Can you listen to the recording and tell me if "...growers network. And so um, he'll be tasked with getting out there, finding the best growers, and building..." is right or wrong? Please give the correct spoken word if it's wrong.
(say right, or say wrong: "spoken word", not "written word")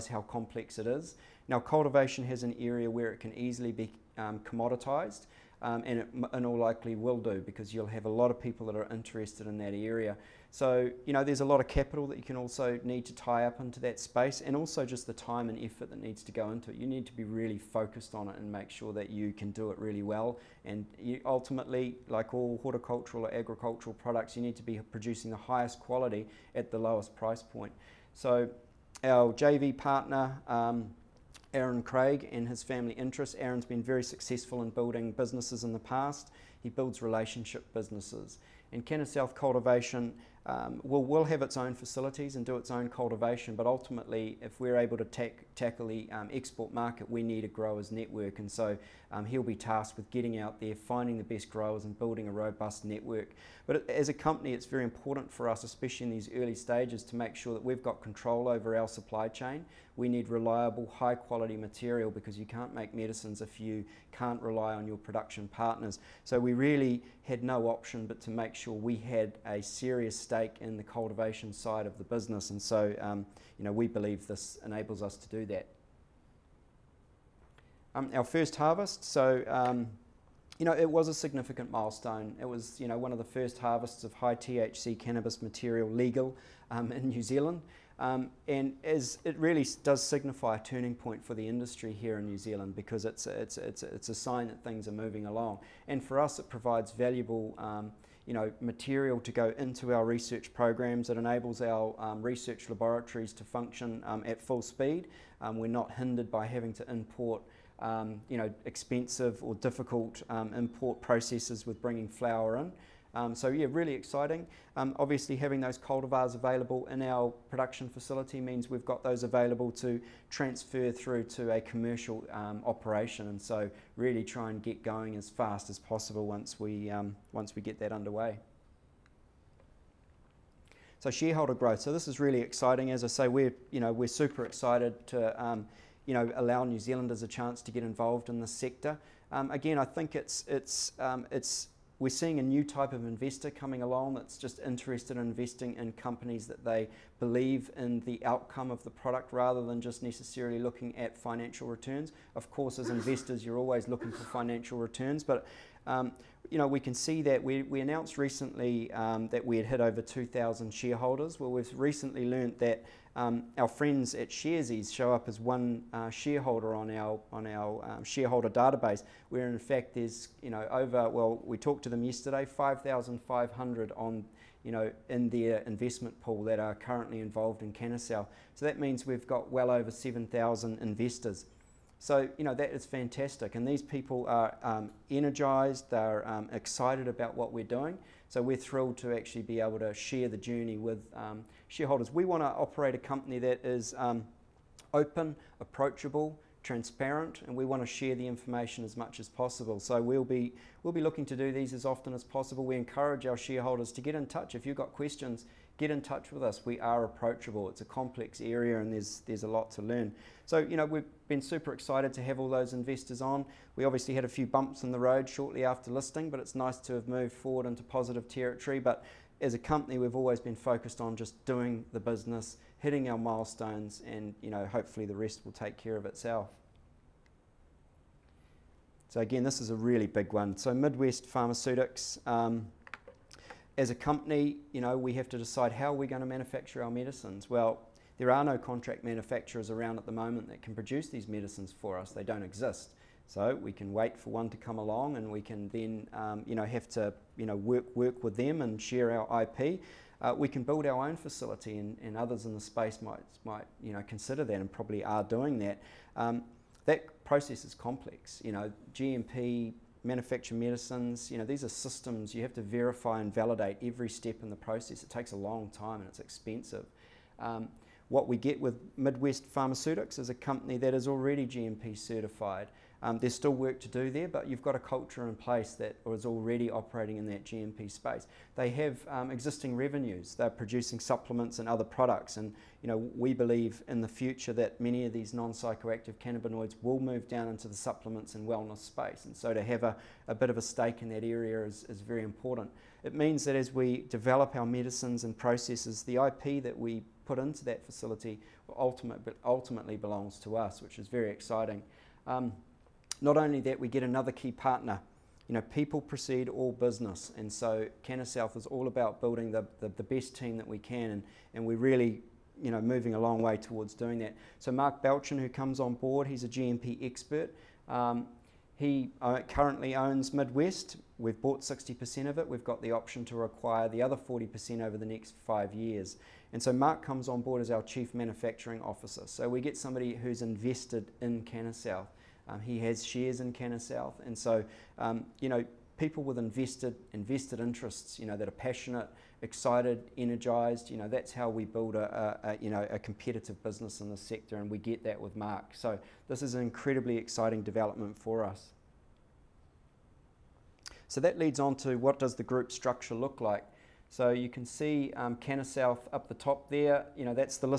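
right.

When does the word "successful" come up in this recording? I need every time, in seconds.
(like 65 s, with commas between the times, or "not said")
34 s.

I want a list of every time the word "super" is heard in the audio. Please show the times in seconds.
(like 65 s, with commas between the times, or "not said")
134 s, 211 s.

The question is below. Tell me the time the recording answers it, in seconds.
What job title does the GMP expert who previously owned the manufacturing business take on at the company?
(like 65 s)
327 s.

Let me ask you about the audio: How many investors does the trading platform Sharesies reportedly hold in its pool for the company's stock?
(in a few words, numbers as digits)
5,500.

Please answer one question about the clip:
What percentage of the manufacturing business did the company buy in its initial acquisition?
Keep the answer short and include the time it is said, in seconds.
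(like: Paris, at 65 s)
60%, at 321 s.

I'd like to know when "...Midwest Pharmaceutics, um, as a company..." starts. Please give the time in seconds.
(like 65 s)
230 s.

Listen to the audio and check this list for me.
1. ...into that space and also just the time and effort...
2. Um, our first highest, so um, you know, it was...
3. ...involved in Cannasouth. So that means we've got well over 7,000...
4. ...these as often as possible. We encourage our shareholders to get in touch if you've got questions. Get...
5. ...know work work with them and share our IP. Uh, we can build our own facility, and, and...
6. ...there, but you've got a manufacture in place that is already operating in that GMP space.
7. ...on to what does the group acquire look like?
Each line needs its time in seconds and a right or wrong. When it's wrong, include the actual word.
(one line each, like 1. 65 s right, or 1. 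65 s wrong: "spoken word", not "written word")
1. 13 s right
2. 77 s wrong: "harvest", not "highest"
3. 177 s right
4. 201 s right
5. 247 s right
6. 274 s wrong: "culture", not "manufacture"
7. 351 s wrong: "structure", not "acquire".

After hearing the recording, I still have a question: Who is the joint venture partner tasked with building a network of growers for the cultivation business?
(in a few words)
Aaron Craig.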